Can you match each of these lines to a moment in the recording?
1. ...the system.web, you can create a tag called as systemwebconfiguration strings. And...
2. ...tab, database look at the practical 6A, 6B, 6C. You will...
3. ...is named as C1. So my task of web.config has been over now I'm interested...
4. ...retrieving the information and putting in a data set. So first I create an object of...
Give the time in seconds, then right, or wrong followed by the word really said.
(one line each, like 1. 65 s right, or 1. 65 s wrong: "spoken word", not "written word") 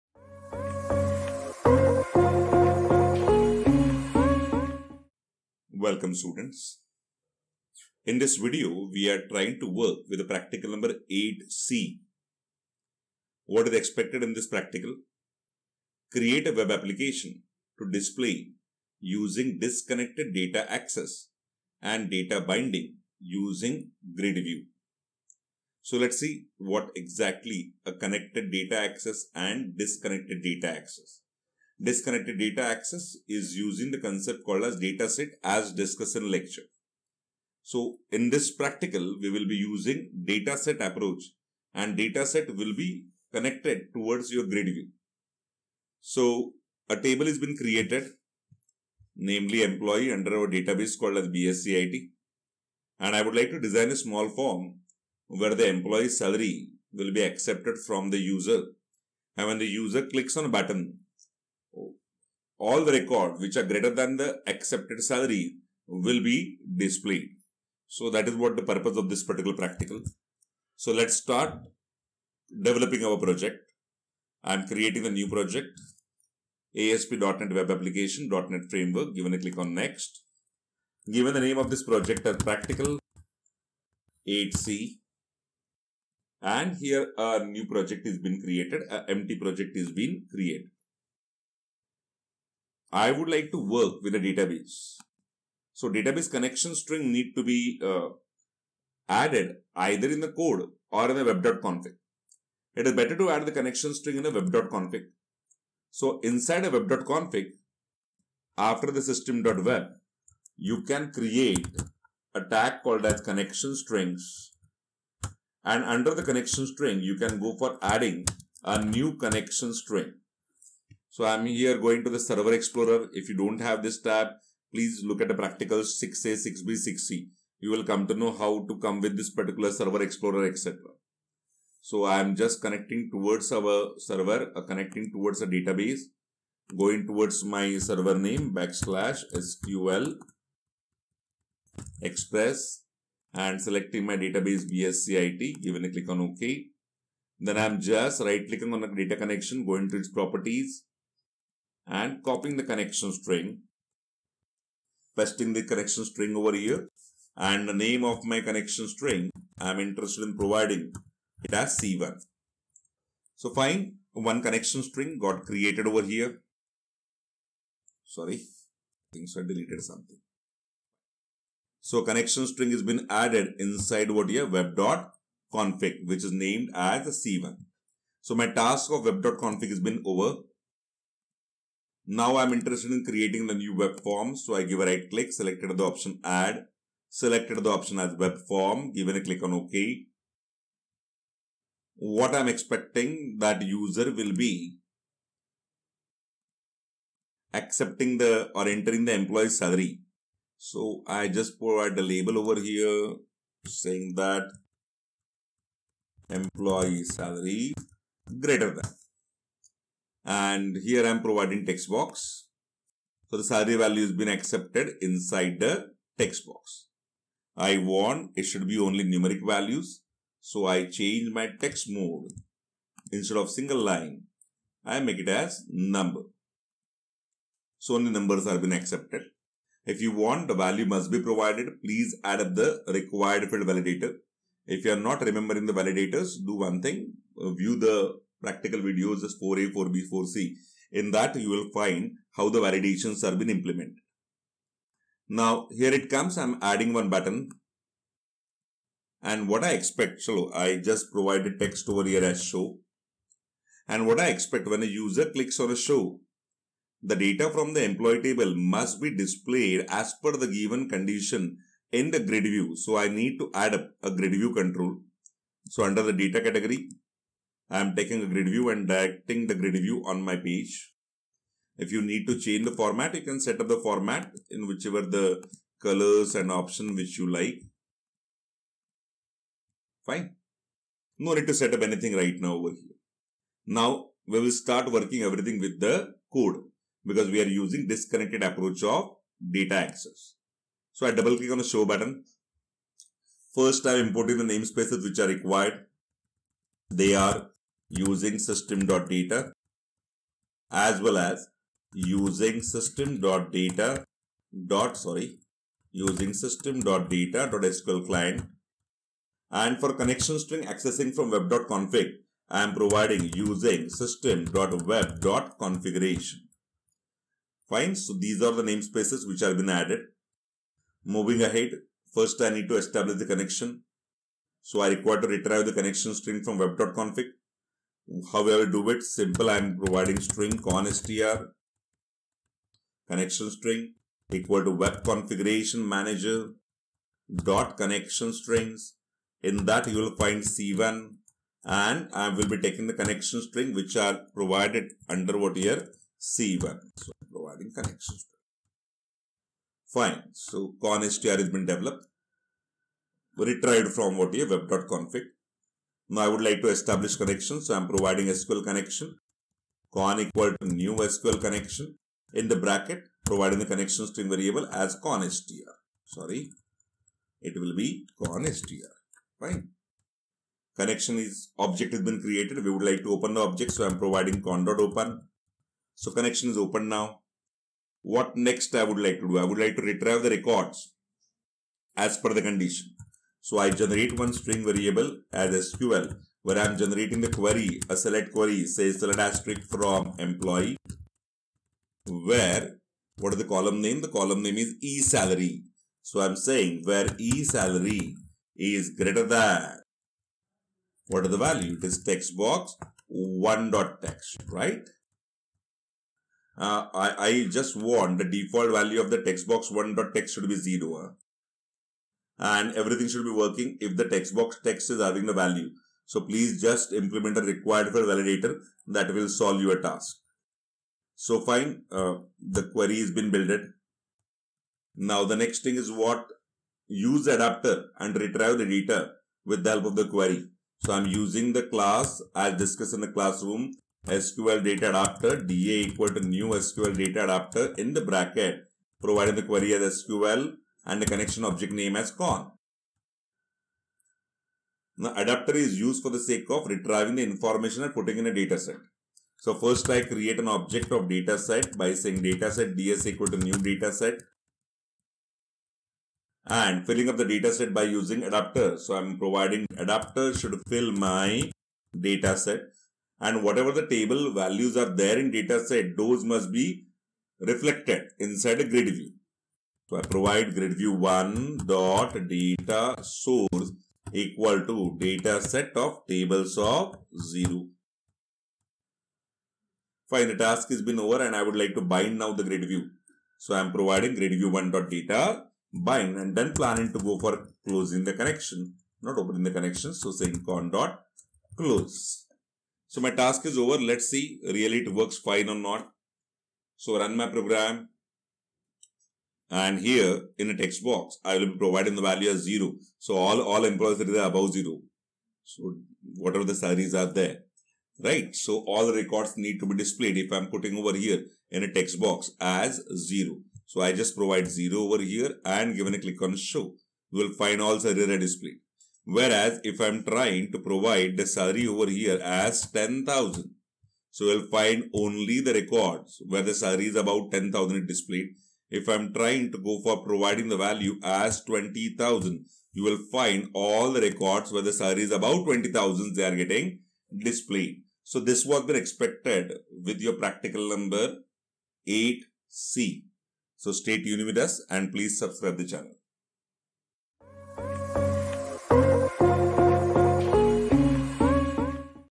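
1. 108 s wrong: "connection", not "systemwebconfiguration"
2. 124 s wrong: "please", not "database"
3. 176 s right
4. 446 s right.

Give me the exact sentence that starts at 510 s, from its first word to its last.
If I'm putting over here in a text box as zero.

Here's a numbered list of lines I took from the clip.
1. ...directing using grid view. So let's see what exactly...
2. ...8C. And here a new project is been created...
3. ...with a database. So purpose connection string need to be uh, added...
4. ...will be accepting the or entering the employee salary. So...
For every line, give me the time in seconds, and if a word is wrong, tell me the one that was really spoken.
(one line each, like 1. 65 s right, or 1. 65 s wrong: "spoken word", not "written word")
1. 22 s wrong: "binding", not "directing"
2. 84 s right
3. 94 s wrong: "database", not "purpose"
4. 194 s right.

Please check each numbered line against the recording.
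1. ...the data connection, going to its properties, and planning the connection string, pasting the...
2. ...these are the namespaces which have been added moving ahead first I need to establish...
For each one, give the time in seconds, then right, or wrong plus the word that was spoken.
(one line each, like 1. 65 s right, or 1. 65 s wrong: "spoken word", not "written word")
1. 148 s wrong: "copying", not "planning"
2. 318 s right.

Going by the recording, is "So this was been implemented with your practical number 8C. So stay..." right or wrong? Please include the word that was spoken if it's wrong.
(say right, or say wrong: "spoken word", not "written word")
wrong: "expected", not "implemented".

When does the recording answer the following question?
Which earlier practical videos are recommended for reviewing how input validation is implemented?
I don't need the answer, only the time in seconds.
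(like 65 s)
239 s.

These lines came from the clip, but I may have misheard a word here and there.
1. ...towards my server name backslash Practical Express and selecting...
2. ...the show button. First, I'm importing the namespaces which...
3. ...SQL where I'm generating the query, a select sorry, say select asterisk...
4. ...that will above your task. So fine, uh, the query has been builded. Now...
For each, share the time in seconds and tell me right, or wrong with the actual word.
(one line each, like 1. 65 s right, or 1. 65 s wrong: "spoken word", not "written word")
1. 137 s wrong: "SQL", not "Practical"
2. 291 s right
3. 385 s wrong: "query", not "sorry"
4. 418 s wrong: "solve", not "above".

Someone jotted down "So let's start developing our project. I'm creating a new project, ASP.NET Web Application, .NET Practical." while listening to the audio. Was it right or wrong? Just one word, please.
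wrong.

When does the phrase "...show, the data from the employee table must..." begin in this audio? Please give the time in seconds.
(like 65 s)
255 s.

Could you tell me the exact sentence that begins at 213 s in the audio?
So the salary value has been accepted inside the text box.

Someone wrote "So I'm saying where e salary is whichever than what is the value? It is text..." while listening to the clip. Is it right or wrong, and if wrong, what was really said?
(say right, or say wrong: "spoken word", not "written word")
wrong: "greater", not "whichever".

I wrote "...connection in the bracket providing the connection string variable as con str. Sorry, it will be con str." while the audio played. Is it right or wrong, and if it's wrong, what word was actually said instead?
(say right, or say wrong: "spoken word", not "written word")
right.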